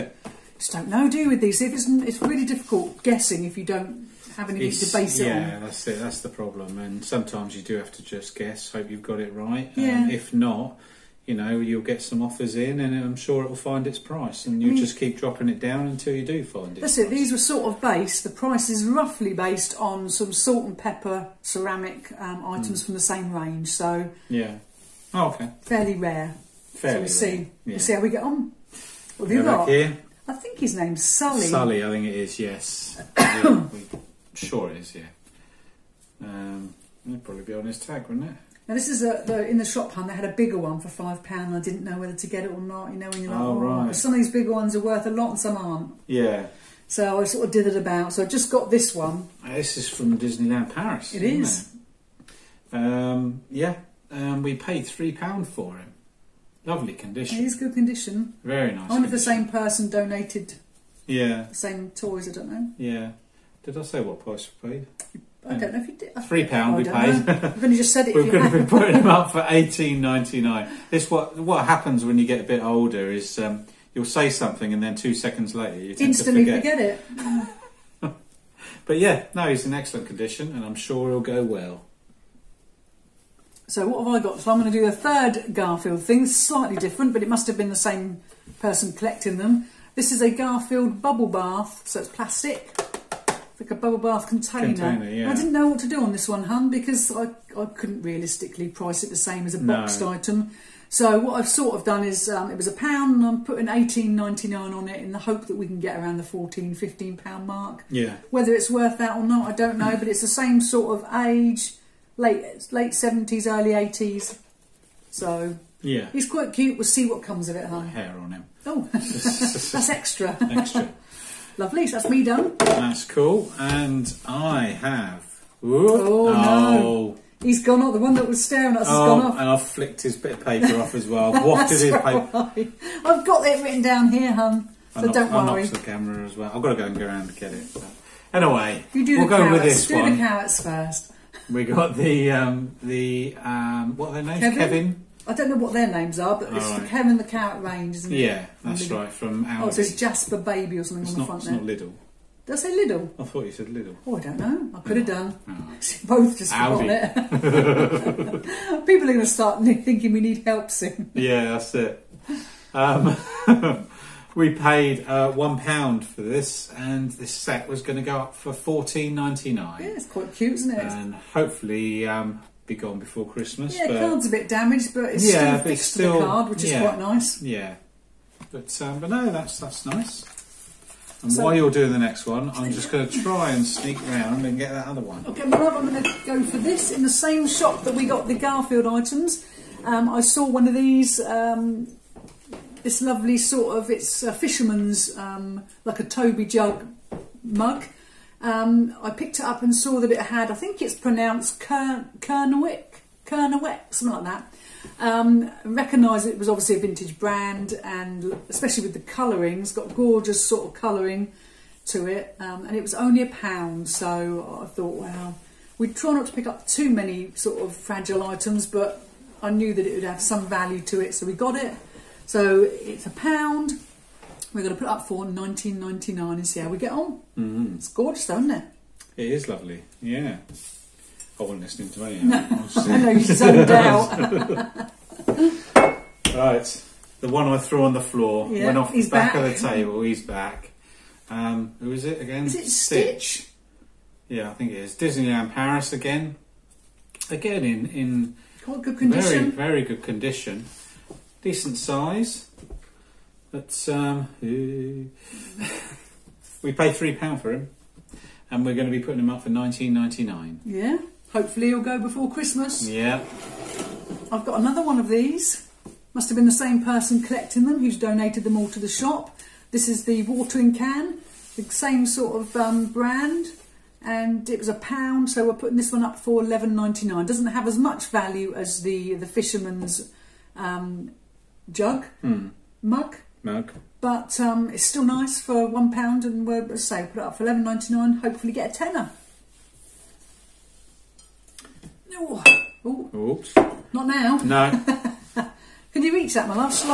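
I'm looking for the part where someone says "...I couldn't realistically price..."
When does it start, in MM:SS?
01:37.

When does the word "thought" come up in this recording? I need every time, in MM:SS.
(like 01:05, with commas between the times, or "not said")
02:33, 03:34.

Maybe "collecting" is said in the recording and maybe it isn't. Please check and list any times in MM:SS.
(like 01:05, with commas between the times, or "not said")
01:28, 04:27.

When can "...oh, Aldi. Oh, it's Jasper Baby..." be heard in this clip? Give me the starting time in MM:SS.
02:29.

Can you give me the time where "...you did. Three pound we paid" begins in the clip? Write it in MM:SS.
01:05.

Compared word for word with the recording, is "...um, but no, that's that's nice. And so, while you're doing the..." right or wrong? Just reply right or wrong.
right.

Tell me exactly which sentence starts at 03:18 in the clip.
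Um, I picked it up and saw that it had, I think it's pronounced Wick, Kernewek, Kernewek, something like that.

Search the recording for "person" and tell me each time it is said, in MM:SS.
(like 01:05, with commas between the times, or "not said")
00:59, 01:28, 04:26.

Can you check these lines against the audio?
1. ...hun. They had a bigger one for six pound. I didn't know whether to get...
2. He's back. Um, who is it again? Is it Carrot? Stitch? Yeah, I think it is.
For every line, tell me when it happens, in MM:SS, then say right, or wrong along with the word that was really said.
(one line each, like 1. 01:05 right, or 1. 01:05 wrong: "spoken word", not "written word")
1. 00:39 wrong: "five", not "six"
2. 04:00 wrong: "Stitch", not "Carrot".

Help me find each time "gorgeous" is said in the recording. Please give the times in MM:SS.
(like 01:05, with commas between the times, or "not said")
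03:29, 03:47.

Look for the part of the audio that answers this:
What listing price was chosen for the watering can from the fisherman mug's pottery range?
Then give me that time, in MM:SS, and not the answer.
04:36.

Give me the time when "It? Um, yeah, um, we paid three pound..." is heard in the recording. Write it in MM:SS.
00:52.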